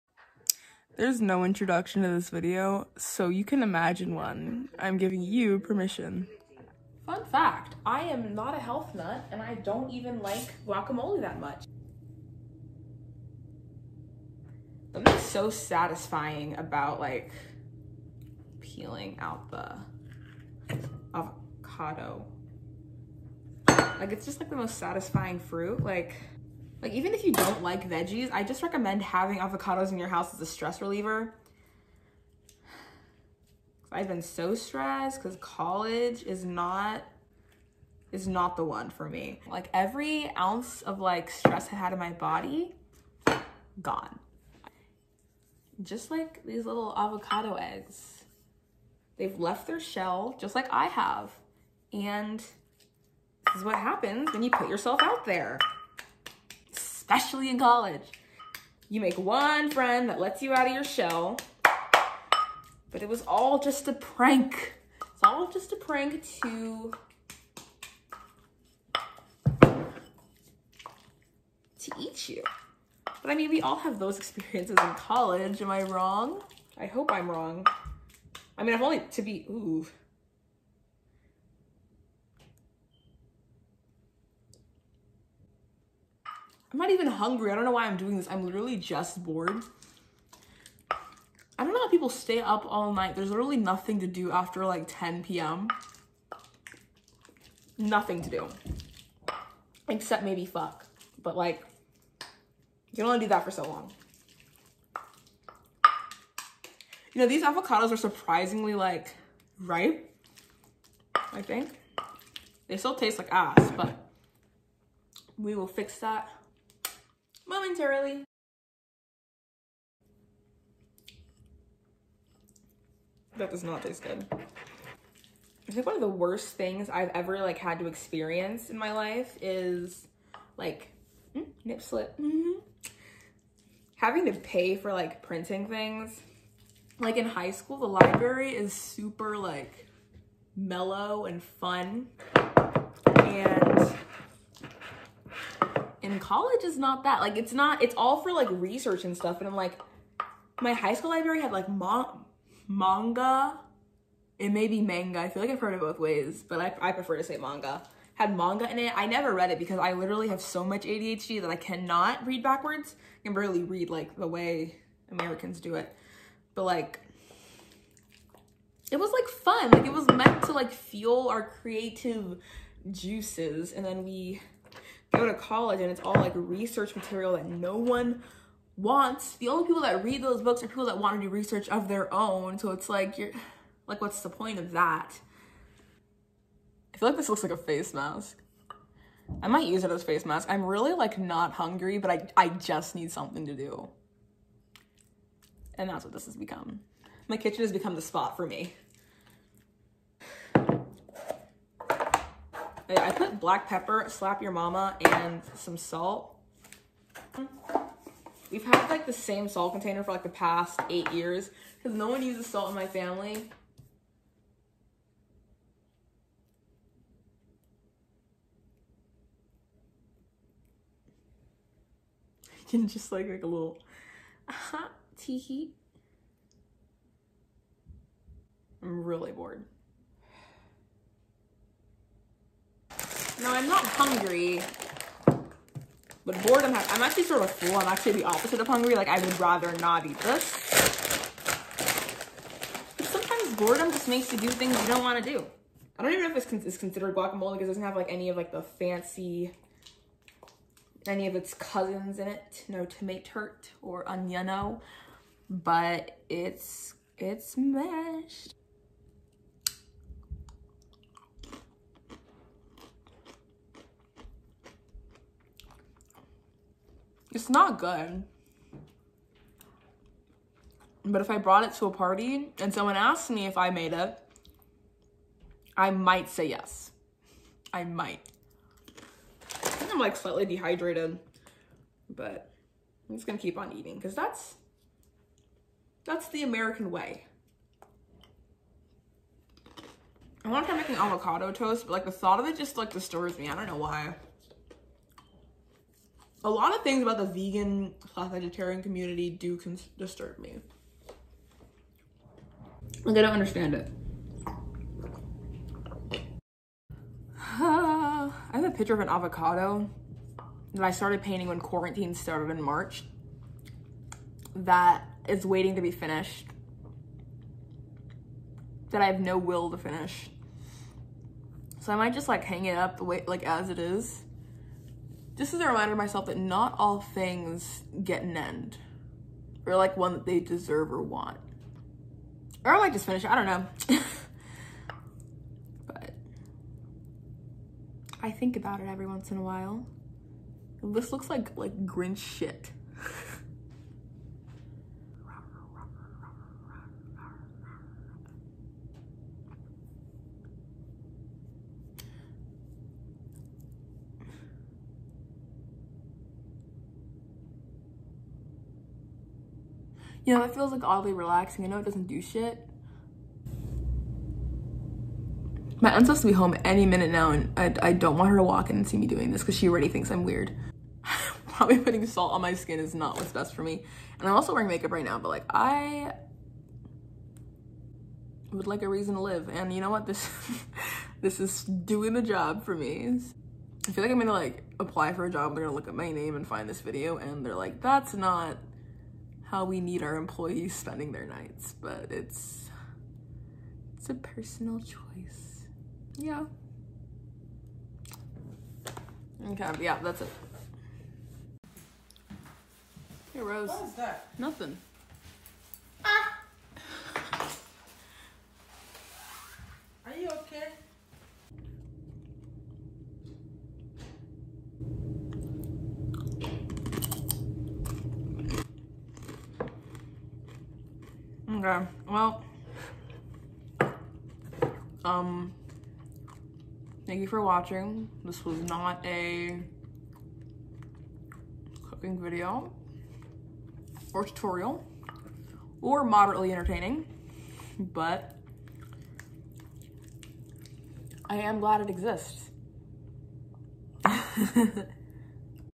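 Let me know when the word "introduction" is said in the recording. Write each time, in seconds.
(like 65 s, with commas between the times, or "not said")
1 s.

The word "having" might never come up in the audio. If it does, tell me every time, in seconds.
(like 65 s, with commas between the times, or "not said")
29 s, 133 s.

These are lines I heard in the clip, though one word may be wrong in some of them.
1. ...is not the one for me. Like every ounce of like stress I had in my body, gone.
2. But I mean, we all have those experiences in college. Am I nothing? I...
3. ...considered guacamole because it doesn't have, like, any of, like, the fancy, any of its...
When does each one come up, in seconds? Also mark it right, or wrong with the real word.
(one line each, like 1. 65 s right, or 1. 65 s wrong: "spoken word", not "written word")
1. 38 s right
2. 73 s wrong: "wrong", not "nothing"
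3. 246 s right.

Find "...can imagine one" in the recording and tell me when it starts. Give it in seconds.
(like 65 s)
3 s.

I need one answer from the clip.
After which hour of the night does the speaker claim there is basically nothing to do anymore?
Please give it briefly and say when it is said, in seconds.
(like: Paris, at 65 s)
10 p.m., at 94 s.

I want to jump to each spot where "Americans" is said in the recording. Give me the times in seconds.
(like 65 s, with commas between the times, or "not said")
165 s, 286 s.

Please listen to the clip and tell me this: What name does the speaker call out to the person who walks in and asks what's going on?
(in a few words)
Rose.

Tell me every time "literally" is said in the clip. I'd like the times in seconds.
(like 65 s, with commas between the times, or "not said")
88 s, 93 s, 159 s.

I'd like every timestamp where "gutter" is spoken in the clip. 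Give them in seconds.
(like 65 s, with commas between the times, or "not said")
not said.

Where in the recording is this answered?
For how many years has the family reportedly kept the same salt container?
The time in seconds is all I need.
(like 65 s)
210 s.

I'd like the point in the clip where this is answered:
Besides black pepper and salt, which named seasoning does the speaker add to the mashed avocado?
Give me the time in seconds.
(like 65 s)
204 s.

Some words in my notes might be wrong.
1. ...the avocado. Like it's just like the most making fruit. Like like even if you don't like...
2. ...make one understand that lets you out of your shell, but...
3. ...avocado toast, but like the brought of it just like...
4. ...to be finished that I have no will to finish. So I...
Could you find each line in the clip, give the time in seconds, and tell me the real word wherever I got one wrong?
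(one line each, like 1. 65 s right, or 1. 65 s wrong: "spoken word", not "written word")
1. 19 s wrong: "satisfying", not "making"
2. 59 s wrong: "friend", not "understand"
3. 290 s wrong: "thought", not "brought"
4. 315 s right.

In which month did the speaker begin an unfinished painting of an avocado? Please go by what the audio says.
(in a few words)
March.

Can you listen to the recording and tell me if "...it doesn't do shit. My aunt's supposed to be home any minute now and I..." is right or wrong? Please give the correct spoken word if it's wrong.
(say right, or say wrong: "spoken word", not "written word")
right.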